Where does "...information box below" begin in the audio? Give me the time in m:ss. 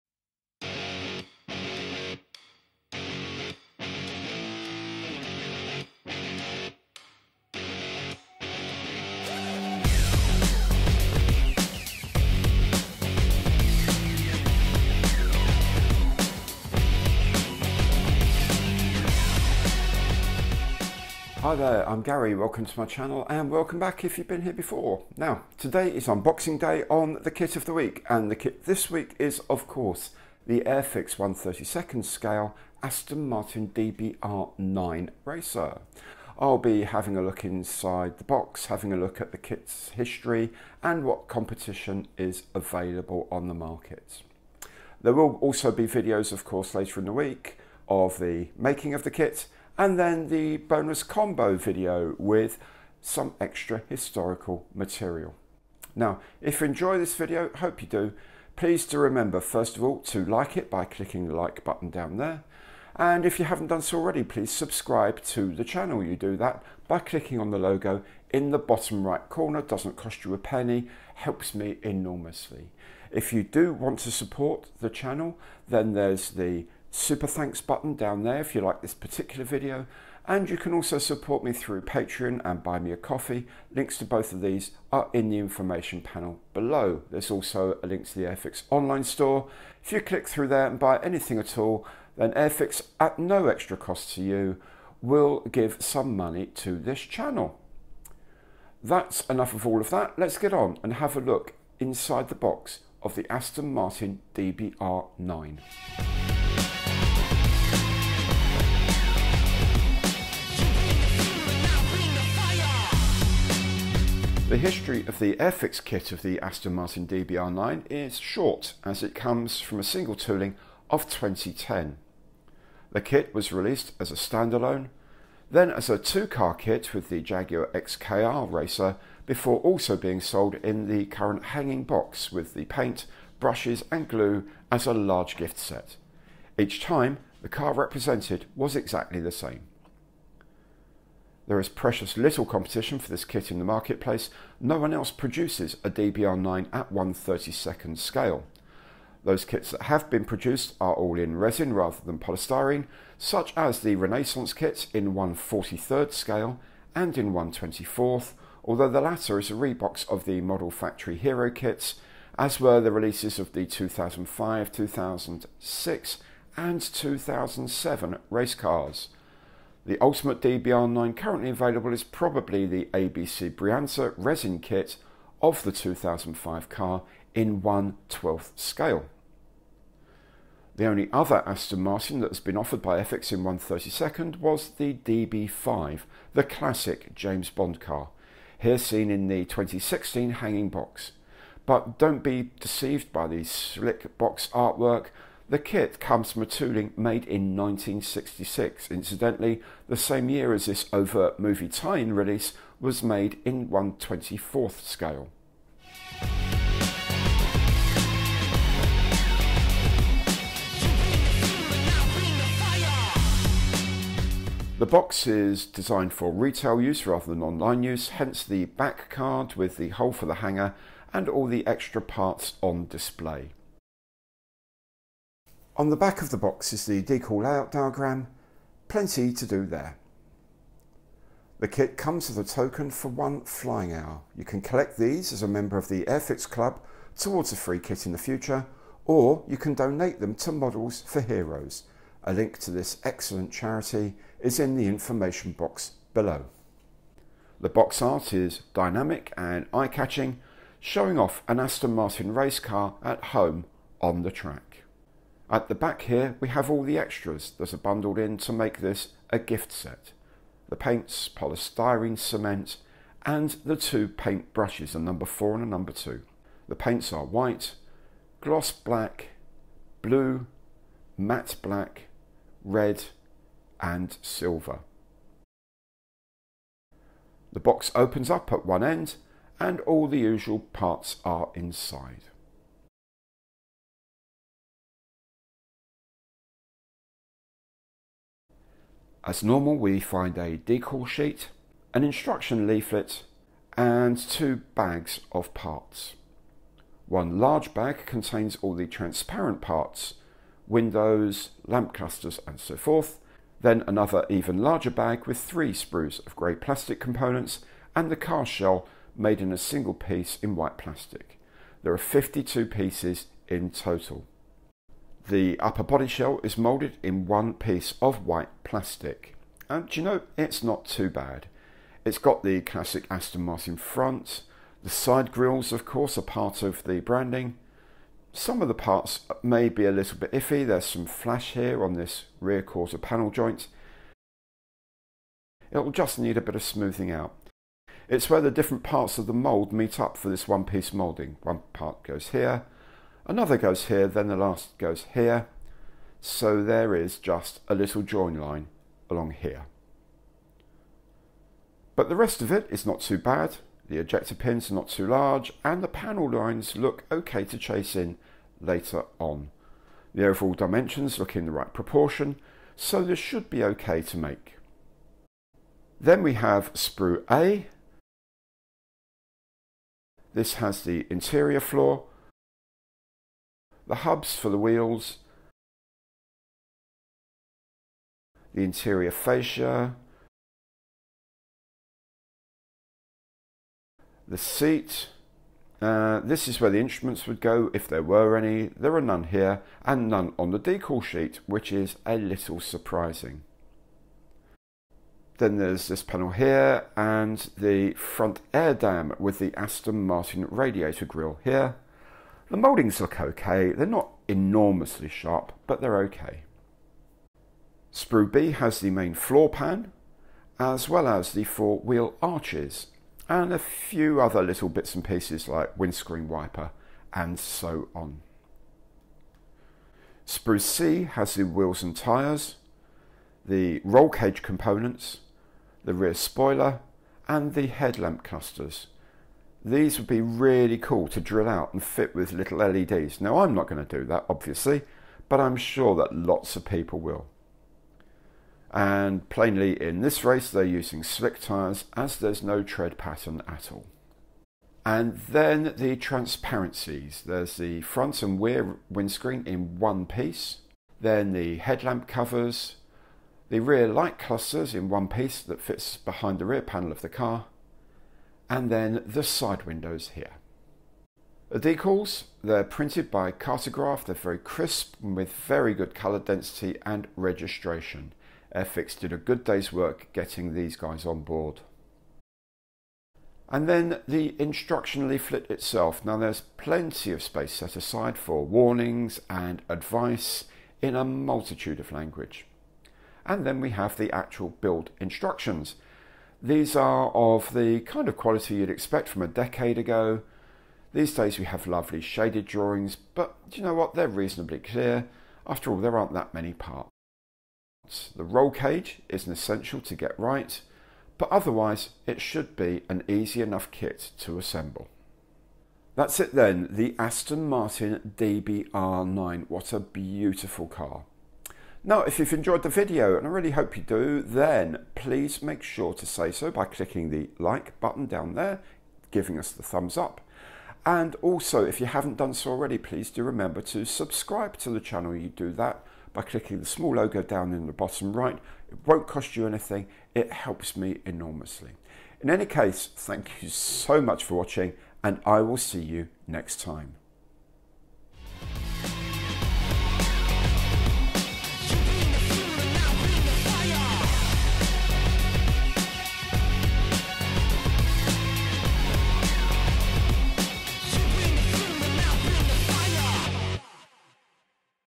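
4:04.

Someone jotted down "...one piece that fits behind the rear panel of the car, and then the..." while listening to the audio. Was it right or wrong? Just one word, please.
right.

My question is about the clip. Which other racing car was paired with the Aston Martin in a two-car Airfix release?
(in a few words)
Jaguar XKR Racer.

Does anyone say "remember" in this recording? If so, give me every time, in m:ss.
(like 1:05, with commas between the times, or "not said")
0:58, 8:43.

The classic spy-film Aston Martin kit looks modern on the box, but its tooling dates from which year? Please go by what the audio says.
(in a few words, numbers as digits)
1966.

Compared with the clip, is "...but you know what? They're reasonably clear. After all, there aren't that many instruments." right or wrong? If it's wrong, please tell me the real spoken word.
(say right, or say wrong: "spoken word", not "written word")
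wrong: "parts", not "instruments".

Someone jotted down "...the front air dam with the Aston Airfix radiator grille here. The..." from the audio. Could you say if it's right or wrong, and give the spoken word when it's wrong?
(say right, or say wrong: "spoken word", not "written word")
wrong: "Martin", not "Airfix".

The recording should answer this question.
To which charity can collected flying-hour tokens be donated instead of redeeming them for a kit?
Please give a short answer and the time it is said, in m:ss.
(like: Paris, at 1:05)
Models for Heroes, at 4:00.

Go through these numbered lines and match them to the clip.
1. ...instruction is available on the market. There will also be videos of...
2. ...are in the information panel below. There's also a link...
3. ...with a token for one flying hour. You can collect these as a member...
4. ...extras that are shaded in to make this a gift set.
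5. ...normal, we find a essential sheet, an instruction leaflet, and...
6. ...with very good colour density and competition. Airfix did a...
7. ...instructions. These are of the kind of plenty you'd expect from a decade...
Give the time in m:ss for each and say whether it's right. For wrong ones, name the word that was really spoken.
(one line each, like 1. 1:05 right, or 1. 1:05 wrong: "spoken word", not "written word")
1. 0:41 wrong: "competition", not "instruction"
2. 1:24 right
3. 3:52 right
4. 4:16 wrong: "bundled", not "shaded"
5. 4:49 wrong: "decal", not "essential"
6. 7:45 wrong: "registration", not "competition"
7. 8:04 wrong: "quality", not "plenty".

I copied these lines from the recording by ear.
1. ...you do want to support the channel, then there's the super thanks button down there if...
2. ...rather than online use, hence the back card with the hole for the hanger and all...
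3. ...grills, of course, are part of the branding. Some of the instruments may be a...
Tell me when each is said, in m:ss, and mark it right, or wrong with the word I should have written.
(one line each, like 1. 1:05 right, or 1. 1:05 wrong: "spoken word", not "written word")
1. 1:13 right
2. 3:37 right
3. 5:25 wrong: "parts", not "instruments".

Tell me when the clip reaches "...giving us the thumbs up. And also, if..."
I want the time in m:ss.
8:39.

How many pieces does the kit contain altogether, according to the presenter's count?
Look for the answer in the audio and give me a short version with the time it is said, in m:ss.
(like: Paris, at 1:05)
52, at 5:11.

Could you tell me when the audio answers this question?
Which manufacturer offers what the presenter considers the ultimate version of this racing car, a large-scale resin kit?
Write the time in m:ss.
2:52.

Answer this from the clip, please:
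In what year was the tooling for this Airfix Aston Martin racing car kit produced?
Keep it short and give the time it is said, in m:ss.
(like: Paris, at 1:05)
2010, at 2:01.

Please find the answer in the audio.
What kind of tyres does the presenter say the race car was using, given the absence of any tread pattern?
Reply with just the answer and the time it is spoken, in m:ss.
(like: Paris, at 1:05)
Slick tyres, at 7:21.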